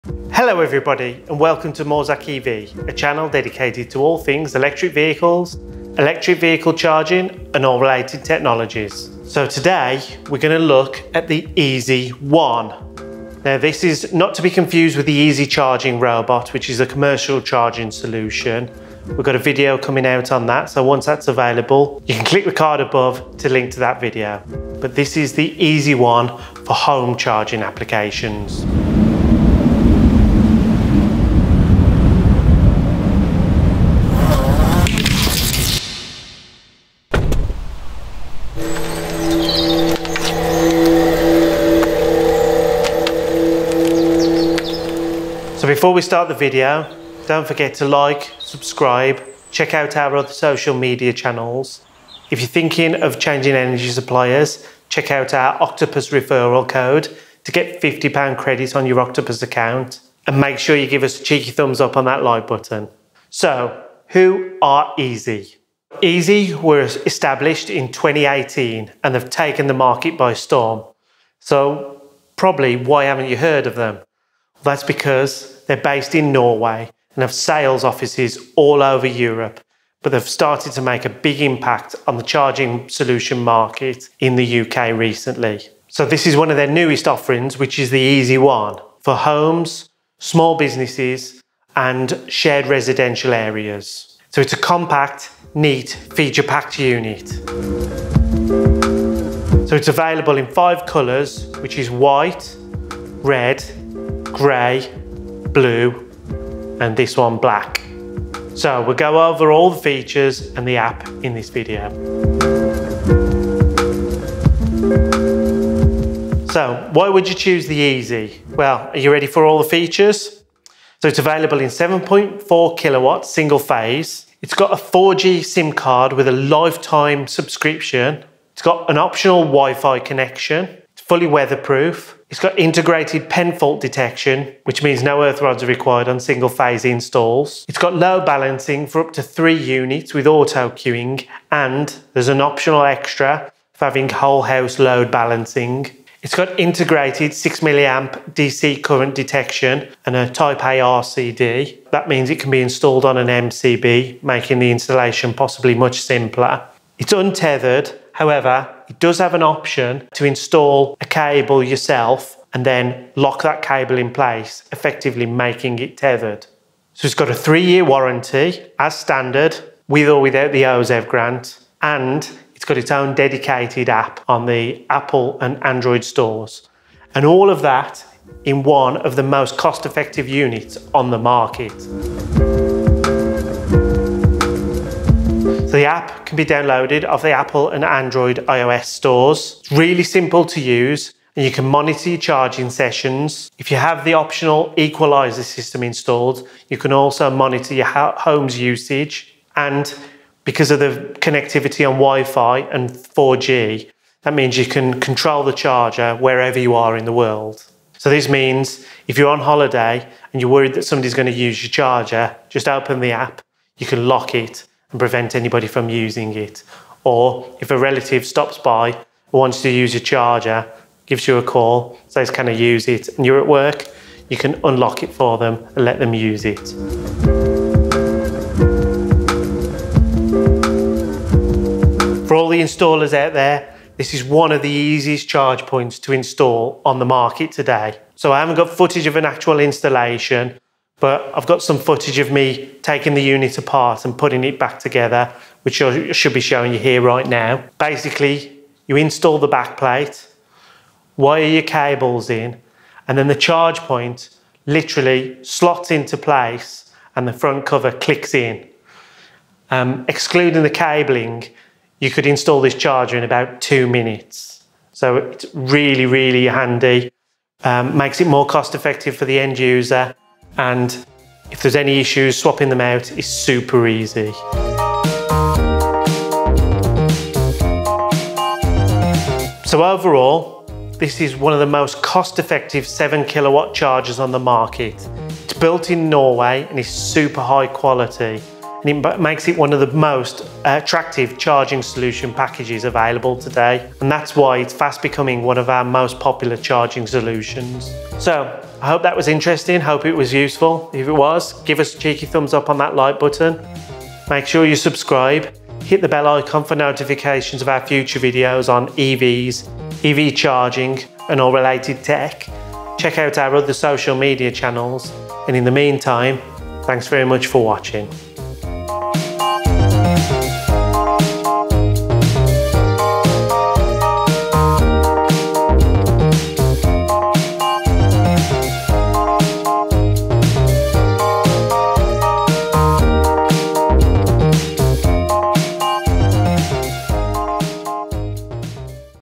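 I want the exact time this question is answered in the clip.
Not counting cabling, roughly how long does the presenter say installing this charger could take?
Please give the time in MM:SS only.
04:23.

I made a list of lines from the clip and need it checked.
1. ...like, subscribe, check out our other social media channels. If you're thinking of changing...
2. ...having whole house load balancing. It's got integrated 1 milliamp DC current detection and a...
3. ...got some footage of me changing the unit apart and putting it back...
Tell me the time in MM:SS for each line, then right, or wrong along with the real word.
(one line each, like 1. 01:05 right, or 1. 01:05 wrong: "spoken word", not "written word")
1. 00:47 right
2. 02:23 wrong: "6", not "1"
3. 04:01 wrong: "taking", not "changing".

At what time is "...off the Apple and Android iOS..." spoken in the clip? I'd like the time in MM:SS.
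03:07.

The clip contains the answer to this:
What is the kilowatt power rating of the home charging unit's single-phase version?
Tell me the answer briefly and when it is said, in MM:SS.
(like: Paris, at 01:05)
7.4, at 02:01.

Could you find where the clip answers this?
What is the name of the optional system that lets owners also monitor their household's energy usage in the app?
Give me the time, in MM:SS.
03:14.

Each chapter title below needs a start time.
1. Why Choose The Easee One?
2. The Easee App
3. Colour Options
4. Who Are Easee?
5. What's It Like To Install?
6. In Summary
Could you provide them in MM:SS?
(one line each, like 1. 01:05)
1. 01:55
2. 03:03
3. 01:41
4. 01:03
5. 03:47
6. 04:35.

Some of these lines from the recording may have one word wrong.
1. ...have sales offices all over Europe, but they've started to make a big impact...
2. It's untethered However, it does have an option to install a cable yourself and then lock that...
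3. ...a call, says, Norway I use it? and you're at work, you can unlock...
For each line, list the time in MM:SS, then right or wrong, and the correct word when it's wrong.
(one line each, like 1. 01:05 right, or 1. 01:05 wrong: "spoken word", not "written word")
1. 01:17 right
2. 02:36 right
3. 03:41 wrong: "Can", not "Norway".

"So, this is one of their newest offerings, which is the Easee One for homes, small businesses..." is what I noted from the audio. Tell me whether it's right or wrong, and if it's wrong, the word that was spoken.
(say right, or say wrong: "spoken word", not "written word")
right.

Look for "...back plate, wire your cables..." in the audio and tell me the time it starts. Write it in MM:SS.
04:09.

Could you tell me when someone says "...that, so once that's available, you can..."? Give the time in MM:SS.
00:20.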